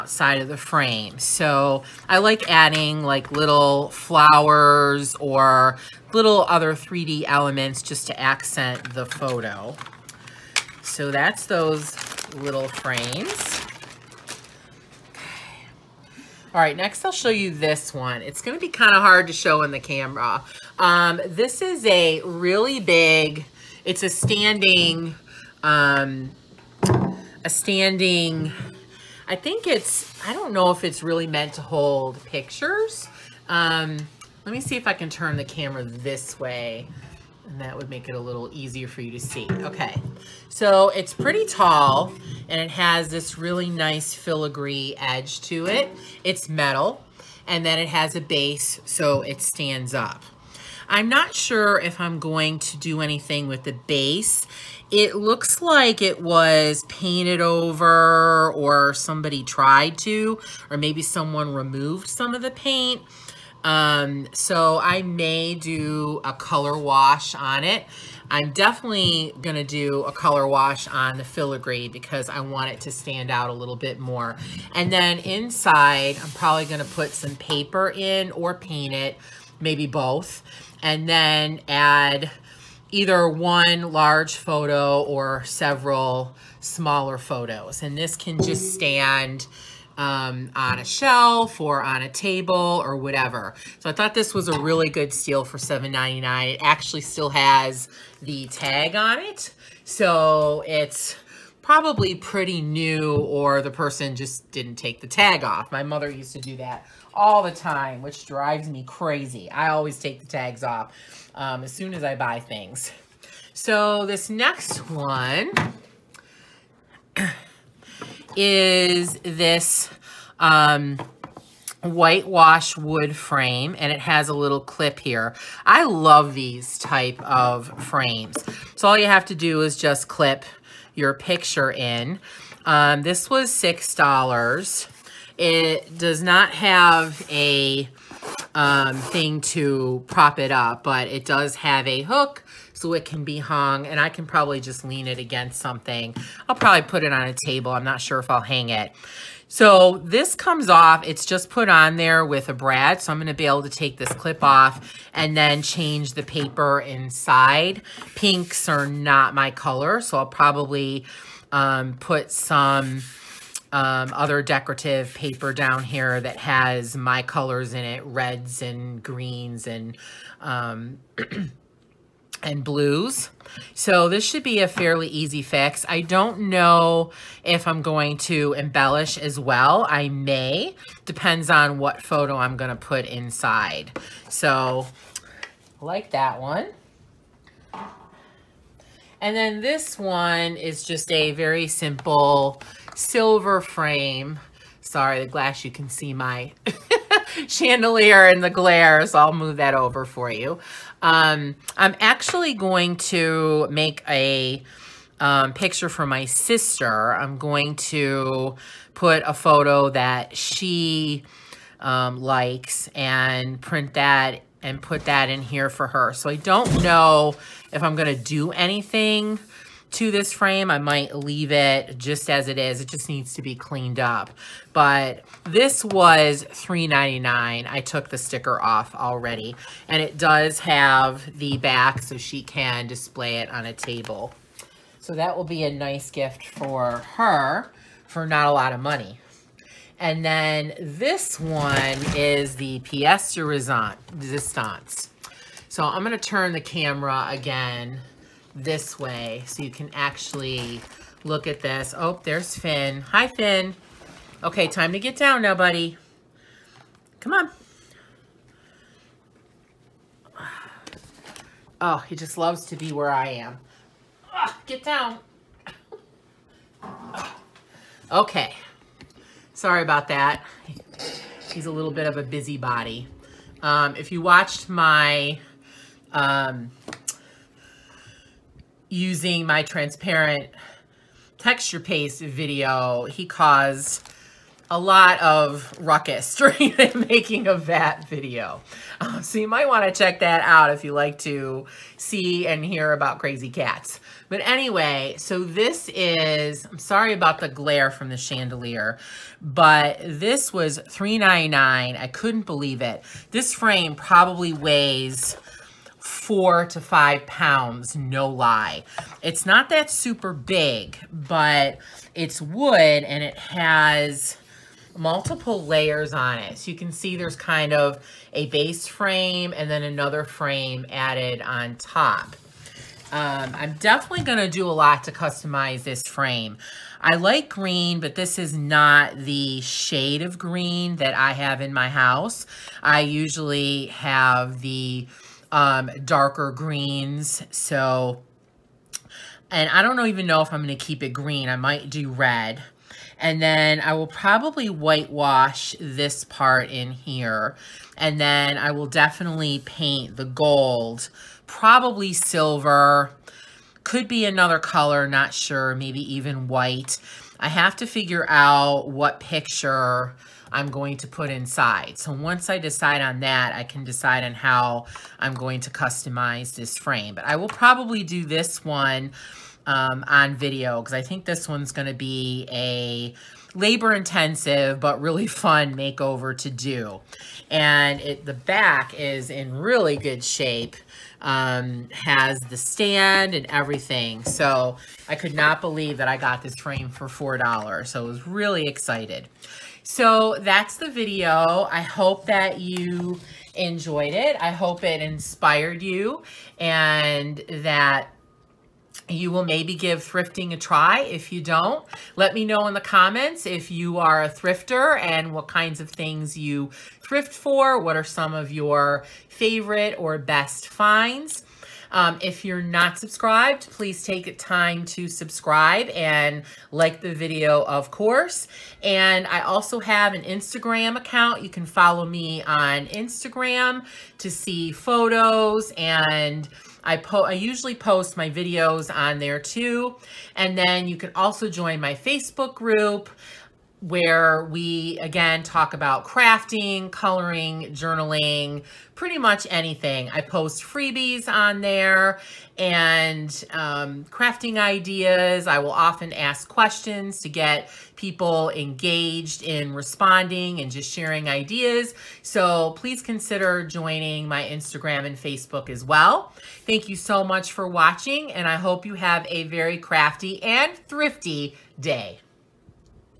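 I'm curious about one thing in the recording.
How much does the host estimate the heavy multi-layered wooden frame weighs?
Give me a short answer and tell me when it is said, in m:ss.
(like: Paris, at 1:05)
4 to 5 pounds, at 5:06.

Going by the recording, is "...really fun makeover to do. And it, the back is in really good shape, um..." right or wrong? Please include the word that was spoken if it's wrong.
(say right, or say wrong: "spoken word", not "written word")
right.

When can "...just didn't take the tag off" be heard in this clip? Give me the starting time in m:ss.
1:44.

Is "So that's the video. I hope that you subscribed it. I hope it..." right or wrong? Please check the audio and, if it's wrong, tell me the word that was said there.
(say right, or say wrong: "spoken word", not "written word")
wrong: "enjoyed", not "subscribed".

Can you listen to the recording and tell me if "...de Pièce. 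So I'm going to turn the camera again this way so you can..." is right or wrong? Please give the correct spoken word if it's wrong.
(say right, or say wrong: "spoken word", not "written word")
wrong: "Resistance", not "Pièce".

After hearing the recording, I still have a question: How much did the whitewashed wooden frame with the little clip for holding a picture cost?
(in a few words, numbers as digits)
$6.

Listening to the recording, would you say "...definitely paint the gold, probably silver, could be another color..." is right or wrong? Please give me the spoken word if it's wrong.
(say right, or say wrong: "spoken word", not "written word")
right.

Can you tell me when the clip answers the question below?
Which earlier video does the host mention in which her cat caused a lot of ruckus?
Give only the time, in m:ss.
4:39.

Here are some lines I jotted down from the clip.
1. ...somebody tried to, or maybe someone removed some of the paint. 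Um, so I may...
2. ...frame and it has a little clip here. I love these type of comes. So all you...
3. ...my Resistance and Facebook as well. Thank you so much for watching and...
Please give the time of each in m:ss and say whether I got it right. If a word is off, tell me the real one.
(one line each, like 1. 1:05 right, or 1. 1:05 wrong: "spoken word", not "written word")
1. 0:58 right
2. 2:03 wrong: "frames", not "comes"
3. 7:34 wrong: "Instagram", not "Resistance".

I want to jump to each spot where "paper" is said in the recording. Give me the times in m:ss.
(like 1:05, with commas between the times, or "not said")
1:17, 2:36, 2:45.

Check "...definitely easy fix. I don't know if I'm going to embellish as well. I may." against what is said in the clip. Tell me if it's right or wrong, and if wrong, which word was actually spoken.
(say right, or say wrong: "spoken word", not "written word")
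wrong: "fairly", not "definitely".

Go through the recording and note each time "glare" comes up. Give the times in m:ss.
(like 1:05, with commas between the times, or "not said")
3:18, 4:57.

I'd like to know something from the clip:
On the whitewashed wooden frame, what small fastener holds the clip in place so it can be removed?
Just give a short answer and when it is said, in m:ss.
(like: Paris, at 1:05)
A brad, at 2:32.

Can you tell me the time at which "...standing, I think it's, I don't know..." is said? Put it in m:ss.
0:27.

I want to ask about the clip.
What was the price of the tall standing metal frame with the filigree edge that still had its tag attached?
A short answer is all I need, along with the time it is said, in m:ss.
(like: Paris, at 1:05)
$7.99, at 1:35.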